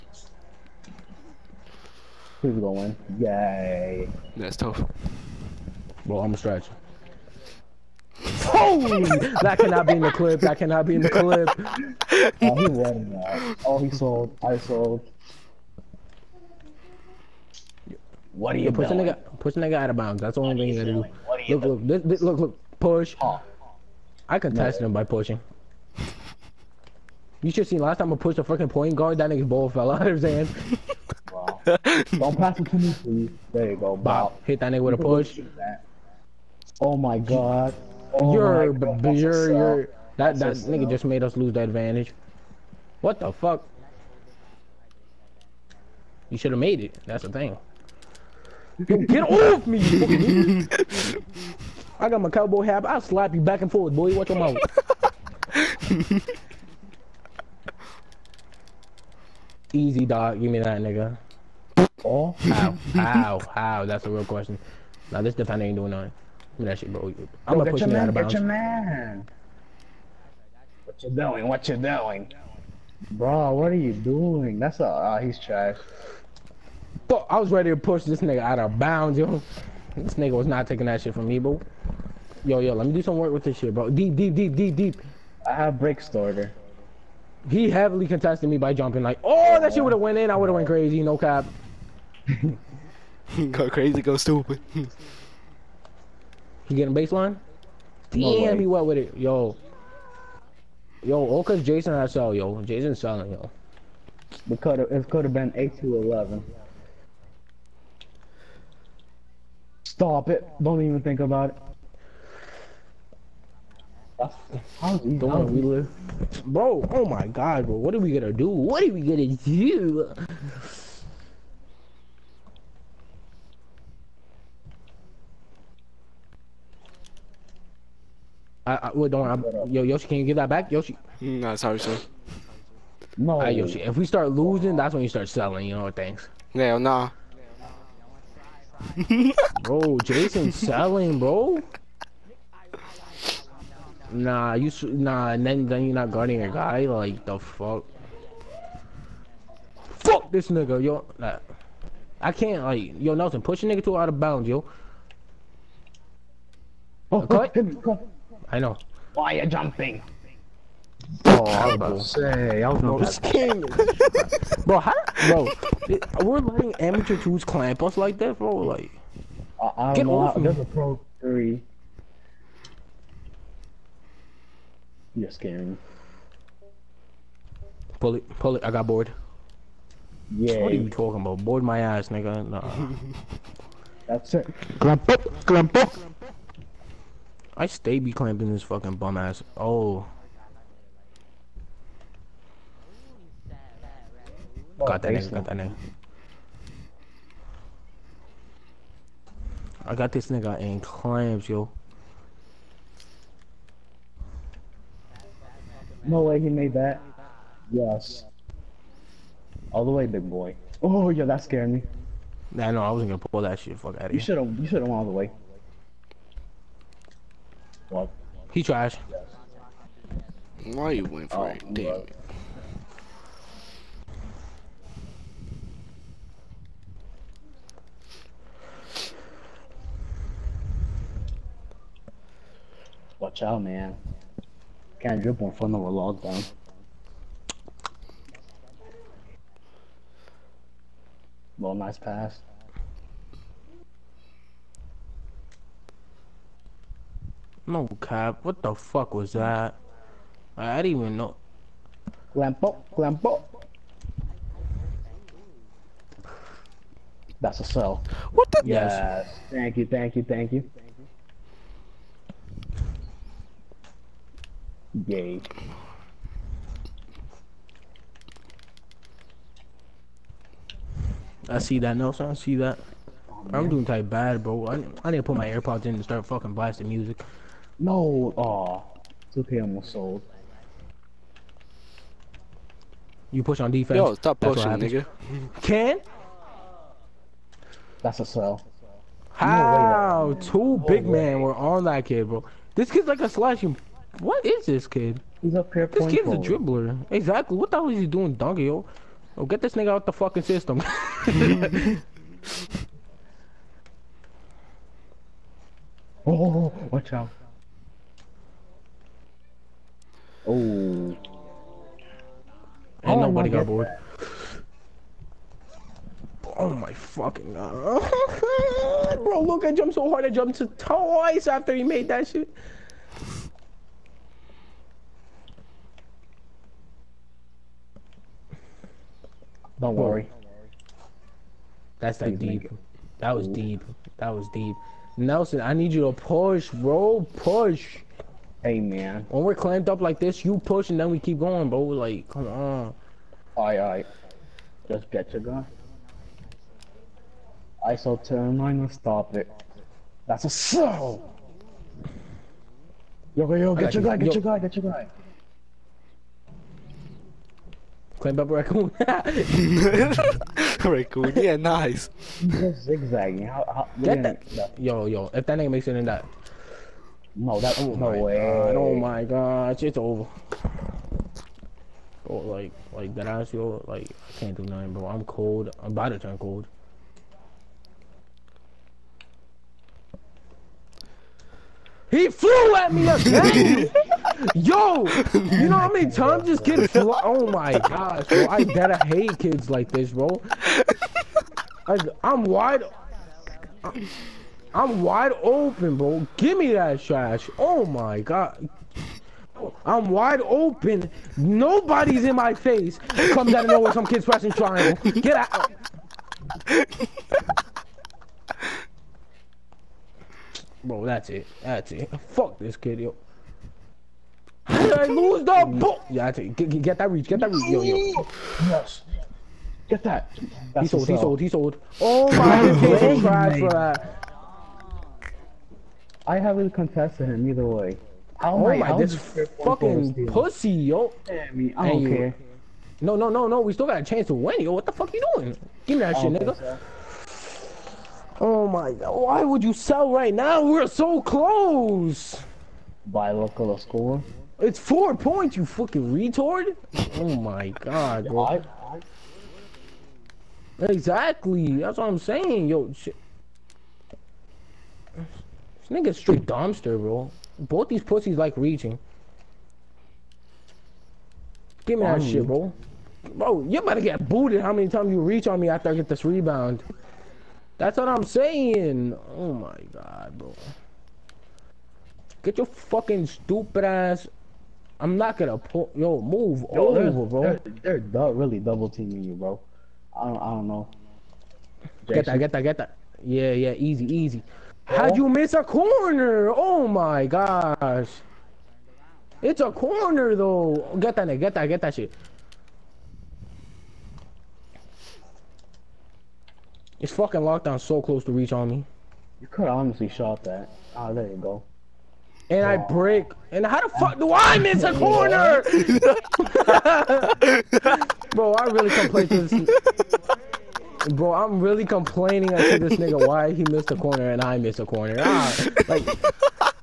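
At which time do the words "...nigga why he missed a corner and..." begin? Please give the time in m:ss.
8:32.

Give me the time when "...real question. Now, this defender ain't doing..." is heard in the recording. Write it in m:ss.
1:04.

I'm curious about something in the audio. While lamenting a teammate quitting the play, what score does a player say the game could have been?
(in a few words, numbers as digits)
8 to 11.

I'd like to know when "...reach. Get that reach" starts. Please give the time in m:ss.
6:57.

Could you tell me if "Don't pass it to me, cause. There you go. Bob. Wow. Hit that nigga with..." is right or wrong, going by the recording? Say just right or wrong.
wrong.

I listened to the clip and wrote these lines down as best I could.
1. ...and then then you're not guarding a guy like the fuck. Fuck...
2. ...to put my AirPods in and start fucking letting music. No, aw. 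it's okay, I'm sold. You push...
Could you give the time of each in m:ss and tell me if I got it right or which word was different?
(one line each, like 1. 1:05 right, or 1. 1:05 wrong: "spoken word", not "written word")
1. 2:25 right
2. 4:35 wrong: "blasting", not "letting".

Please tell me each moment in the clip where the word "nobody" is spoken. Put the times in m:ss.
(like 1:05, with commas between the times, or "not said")
5:13, 6:41.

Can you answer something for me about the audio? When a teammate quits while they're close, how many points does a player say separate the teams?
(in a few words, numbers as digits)
4.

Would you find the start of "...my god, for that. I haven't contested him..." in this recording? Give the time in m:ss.
7:02.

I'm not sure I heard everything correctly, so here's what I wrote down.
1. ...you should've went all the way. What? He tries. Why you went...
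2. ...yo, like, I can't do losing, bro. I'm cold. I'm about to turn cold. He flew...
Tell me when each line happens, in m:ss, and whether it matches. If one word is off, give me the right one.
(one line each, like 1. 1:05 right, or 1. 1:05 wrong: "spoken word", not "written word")
1. 3:34 right
2. 6:13 wrong: "nothing", not "losing".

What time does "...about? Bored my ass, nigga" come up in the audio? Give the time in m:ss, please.
3:01.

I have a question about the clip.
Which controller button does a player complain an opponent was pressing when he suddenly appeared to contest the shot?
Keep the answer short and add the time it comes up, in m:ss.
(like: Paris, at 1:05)
triangle, at 6:44.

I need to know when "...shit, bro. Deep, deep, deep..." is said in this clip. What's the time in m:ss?
1:23.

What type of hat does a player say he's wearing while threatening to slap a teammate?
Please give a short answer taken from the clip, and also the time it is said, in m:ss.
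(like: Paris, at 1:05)
cowboy hat, at 0:52.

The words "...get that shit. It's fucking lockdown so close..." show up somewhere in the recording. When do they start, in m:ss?
8:11.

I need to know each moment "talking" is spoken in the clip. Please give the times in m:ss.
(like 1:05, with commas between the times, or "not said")
3:00.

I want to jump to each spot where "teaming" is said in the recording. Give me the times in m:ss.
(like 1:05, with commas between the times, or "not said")
7:58.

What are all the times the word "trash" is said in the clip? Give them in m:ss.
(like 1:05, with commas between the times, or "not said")
1:15, 6:37.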